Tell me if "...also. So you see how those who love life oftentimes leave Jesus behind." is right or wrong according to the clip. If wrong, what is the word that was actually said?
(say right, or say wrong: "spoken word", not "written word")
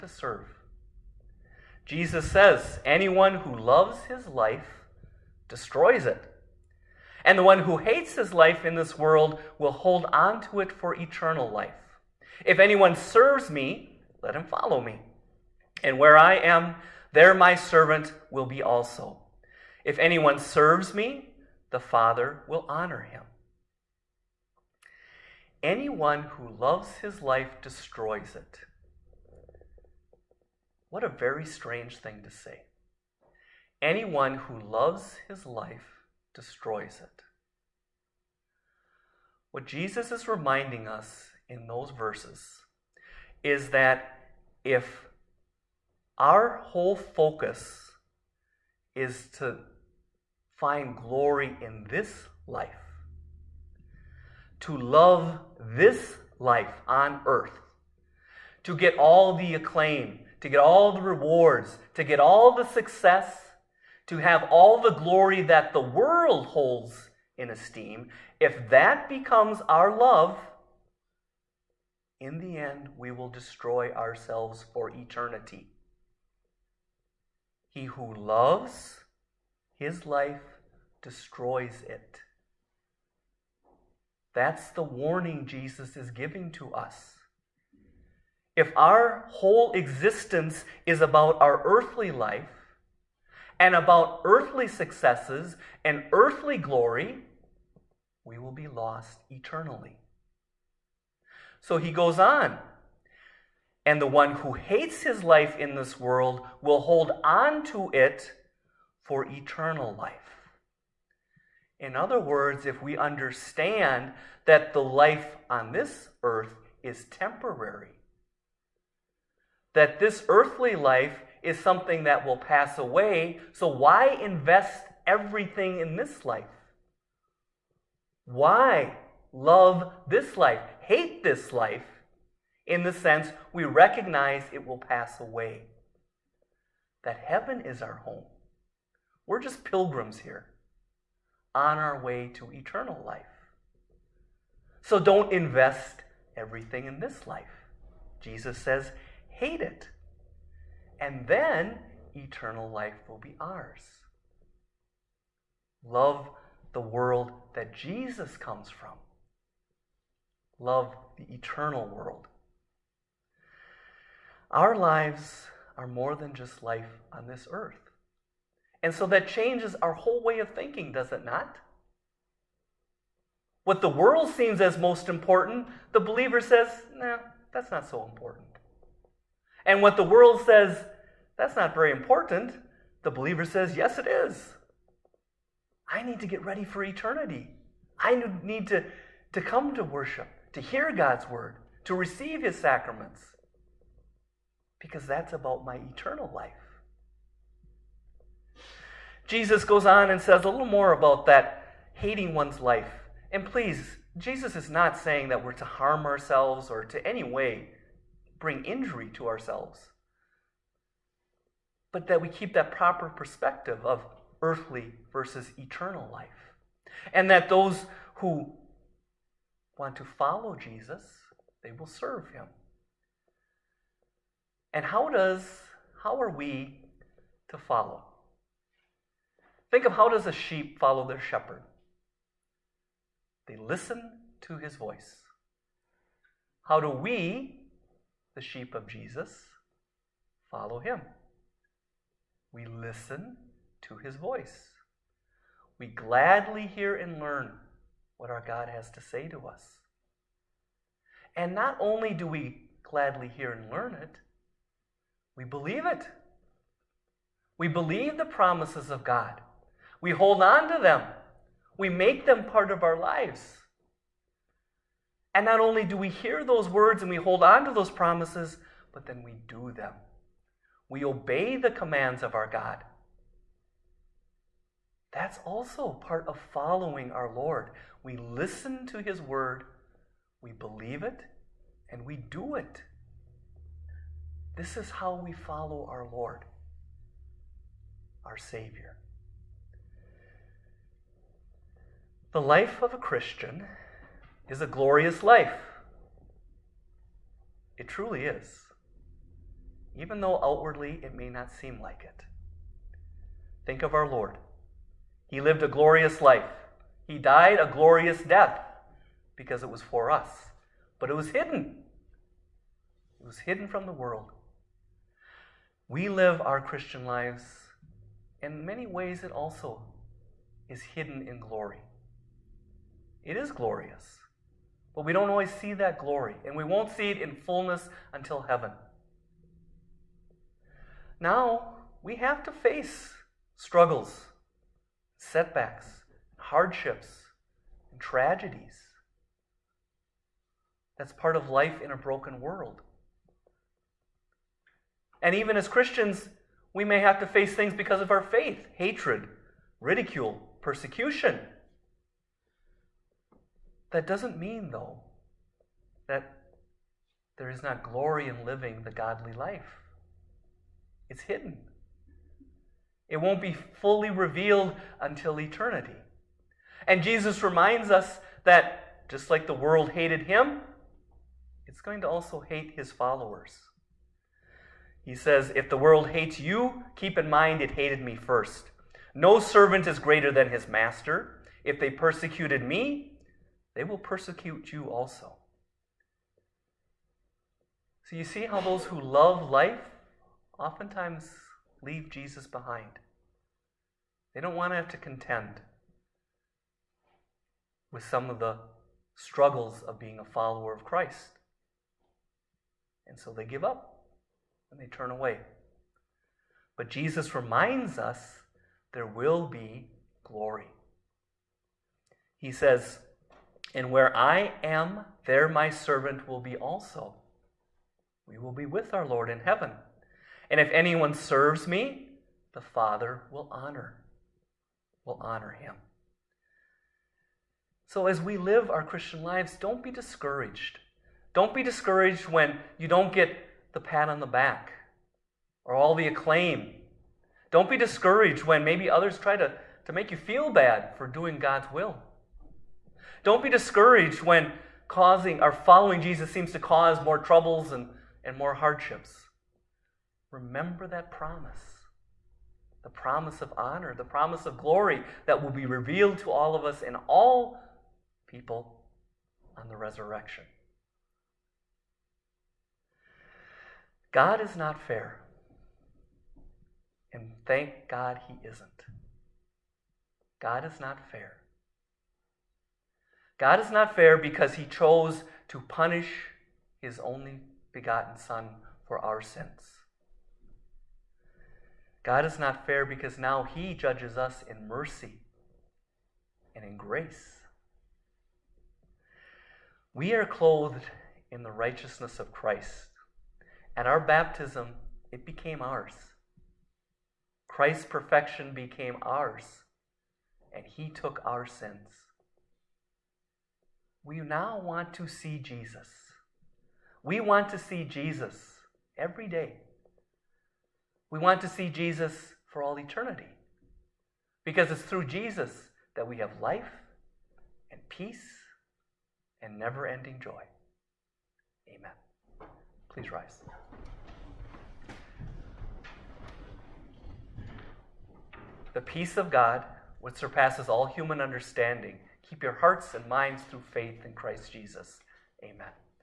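right.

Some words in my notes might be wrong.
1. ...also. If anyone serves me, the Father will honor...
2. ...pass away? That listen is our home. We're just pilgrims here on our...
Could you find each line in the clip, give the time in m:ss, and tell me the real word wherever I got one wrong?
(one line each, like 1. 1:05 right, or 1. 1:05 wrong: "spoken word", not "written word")
1. 0:18 right
2. 2:14 wrong: "heaven", not "listen".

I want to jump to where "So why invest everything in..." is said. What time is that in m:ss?
2:03.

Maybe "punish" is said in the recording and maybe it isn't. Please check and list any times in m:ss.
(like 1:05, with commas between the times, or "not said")
7:55.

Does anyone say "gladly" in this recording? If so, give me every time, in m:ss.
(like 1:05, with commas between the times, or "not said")
4:05, 4:12.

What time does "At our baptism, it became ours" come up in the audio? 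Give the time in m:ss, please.
8:13.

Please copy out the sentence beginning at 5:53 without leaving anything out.
That doesn't mean, though, that there is not glory in living the godly life.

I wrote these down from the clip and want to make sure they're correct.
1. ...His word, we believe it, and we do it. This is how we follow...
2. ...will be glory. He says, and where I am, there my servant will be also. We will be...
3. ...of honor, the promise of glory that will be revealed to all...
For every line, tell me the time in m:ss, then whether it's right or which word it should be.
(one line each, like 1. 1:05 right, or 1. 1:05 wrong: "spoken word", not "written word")
1. 4:39 right
2. 6:49 right
3. 7:33 right.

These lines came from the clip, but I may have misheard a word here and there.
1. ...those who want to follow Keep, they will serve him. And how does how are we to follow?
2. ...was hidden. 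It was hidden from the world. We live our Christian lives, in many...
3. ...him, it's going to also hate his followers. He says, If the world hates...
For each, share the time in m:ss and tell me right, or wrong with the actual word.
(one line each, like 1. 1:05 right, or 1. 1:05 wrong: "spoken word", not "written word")
1. 3:37 wrong: "Jesus", not "Keep"
2. 5:11 right
3. 6:10 right.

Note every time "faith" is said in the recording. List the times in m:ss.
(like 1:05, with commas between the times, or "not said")
5:48, 8:53.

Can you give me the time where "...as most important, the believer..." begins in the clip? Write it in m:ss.
2:54.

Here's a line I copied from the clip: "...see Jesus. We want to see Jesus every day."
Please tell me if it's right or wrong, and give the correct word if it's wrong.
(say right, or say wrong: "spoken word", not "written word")
right.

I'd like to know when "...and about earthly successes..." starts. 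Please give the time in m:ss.
1:33.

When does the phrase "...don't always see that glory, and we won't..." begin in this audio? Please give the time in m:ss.
5:25.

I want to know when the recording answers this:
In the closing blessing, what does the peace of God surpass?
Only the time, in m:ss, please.
8:50.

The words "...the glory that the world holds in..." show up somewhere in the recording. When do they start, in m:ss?
1:04.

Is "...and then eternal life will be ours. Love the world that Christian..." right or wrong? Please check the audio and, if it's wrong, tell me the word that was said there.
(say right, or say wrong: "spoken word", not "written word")
wrong: "Jesus", not "Christian".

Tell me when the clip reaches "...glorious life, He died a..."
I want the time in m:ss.
5:05.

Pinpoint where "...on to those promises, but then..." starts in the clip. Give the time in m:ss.
4:27.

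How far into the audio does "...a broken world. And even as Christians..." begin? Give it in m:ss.
5:41.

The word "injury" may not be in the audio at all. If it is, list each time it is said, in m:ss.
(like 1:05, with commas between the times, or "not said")
3:28.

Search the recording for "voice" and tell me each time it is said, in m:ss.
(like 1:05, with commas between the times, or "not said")
3:54, 4:04.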